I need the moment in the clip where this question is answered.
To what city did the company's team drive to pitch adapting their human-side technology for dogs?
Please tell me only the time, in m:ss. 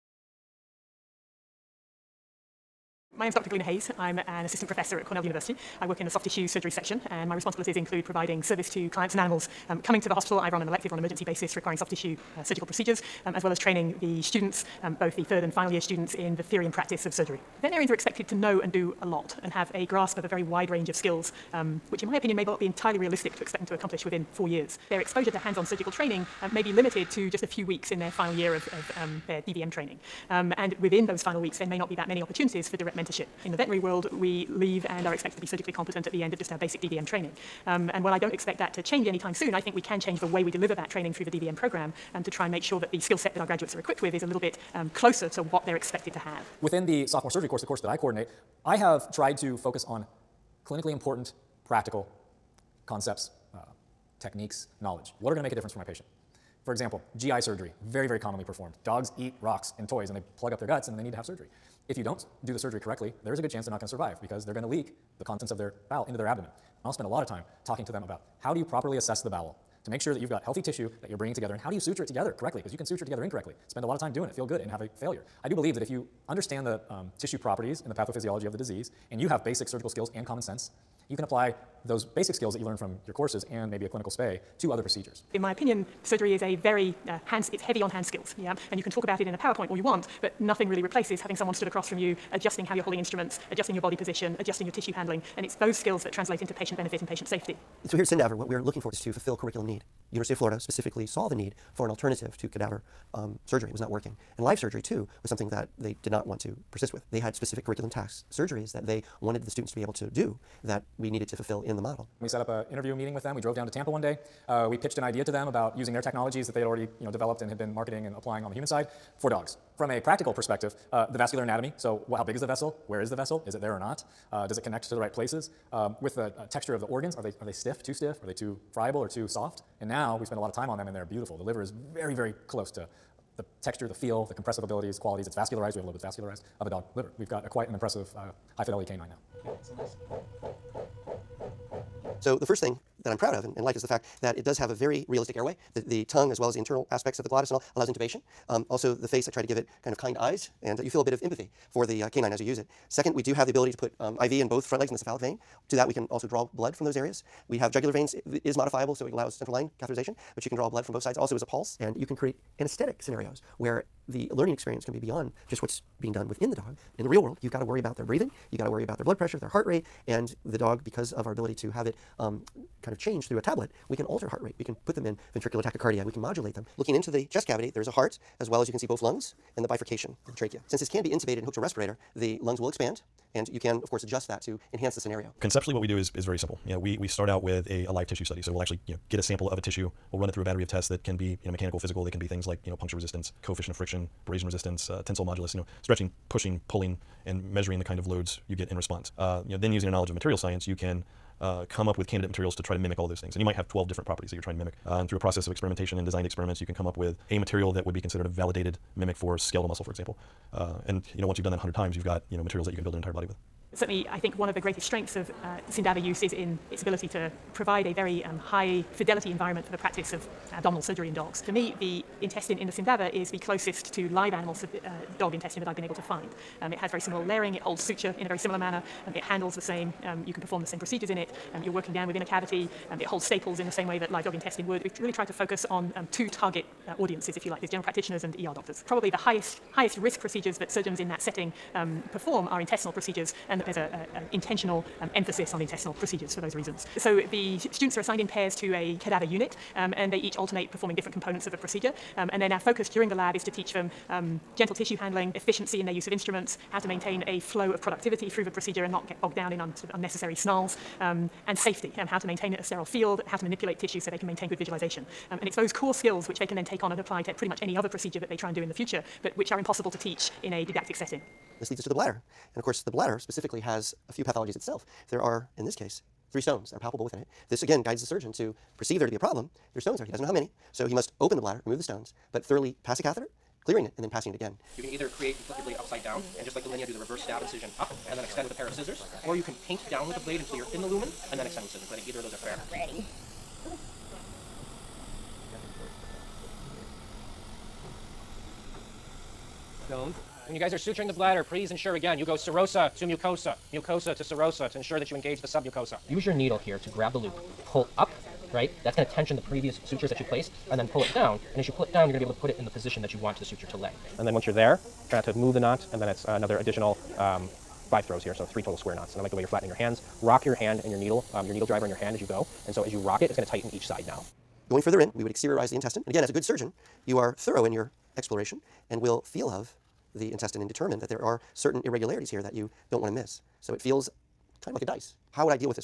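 1:53.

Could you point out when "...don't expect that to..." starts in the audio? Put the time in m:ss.
0:38.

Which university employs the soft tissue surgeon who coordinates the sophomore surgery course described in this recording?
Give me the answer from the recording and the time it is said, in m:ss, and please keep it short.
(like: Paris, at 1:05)
Cornell University, at 0:05.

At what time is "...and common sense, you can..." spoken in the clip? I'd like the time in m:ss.
1:20.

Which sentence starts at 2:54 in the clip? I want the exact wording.
We can put them in ventricular tachycardia.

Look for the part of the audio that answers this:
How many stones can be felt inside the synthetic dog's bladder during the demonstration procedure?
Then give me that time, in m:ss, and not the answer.
4:36.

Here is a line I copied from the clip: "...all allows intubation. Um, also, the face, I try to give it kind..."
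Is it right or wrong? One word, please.
right.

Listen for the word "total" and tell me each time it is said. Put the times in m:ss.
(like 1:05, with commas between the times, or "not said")
5:18.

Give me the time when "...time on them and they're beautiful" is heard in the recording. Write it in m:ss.
2:10.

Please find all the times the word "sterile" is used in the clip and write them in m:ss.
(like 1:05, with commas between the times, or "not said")
4:22.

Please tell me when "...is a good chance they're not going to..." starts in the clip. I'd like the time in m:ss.
1:03.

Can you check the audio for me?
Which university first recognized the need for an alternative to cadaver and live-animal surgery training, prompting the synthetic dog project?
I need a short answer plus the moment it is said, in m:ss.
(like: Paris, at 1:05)
University of Florida, at 1:40.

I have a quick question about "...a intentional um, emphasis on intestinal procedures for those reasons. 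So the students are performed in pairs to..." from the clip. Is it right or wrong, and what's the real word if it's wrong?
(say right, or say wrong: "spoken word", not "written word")
wrong: "assigned", not "performed".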